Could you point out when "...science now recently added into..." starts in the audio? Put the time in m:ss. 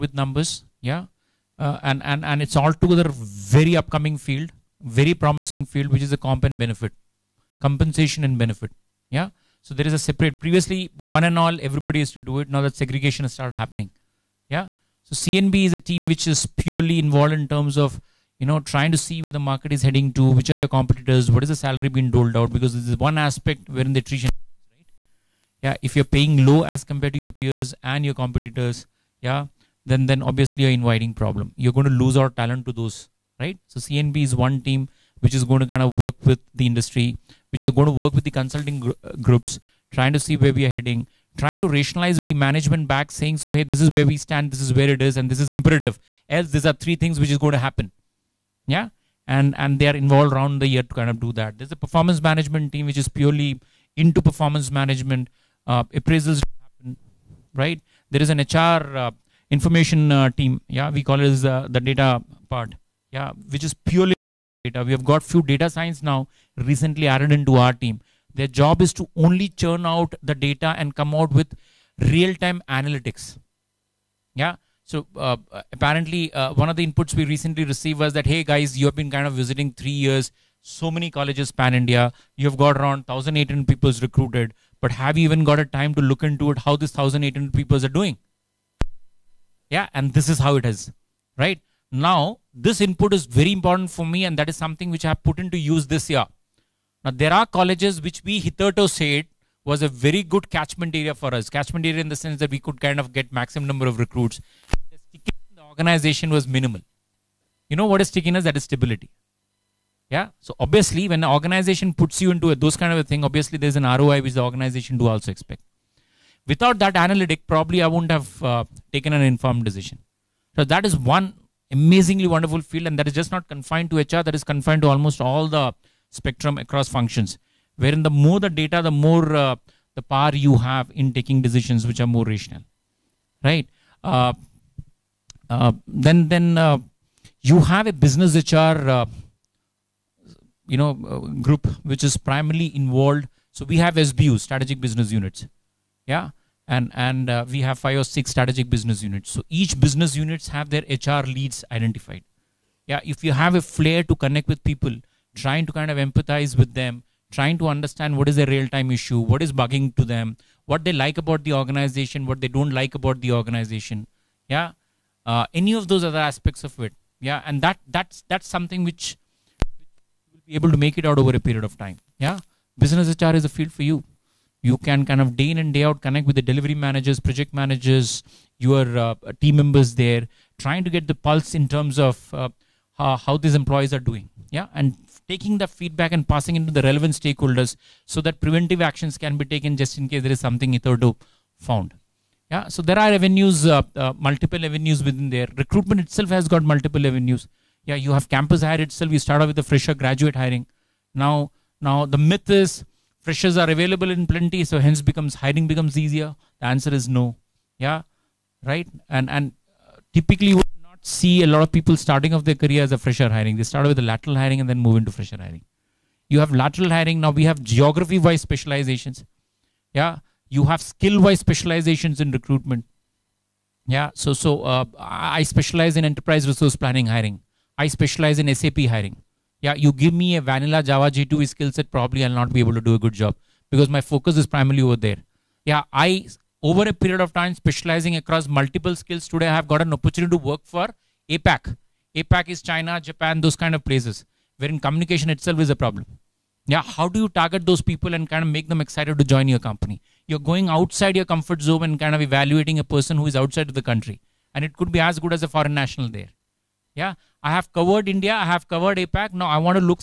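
1:05.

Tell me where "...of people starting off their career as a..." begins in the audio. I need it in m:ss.
3:31.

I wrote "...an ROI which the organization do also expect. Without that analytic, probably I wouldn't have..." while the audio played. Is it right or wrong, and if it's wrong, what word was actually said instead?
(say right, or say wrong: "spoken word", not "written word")
right.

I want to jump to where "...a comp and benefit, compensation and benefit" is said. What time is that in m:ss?
0:06.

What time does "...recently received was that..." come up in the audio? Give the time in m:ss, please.
1:17.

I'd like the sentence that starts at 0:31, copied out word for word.
You're going to lose our talent to those.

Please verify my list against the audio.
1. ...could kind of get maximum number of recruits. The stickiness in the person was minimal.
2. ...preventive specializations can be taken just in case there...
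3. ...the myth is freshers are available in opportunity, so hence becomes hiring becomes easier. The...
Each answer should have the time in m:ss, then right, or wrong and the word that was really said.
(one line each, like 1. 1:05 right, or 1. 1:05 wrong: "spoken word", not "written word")
1. 1:42 wrong: "organization", not "person"
2. 3:08 wrong: "actions", not "specializations"
3. 3:22 wrong: "plenty", not "opportunity".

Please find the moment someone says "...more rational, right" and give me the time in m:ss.
2:12.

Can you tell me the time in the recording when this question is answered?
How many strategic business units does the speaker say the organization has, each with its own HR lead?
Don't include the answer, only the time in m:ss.
2:27.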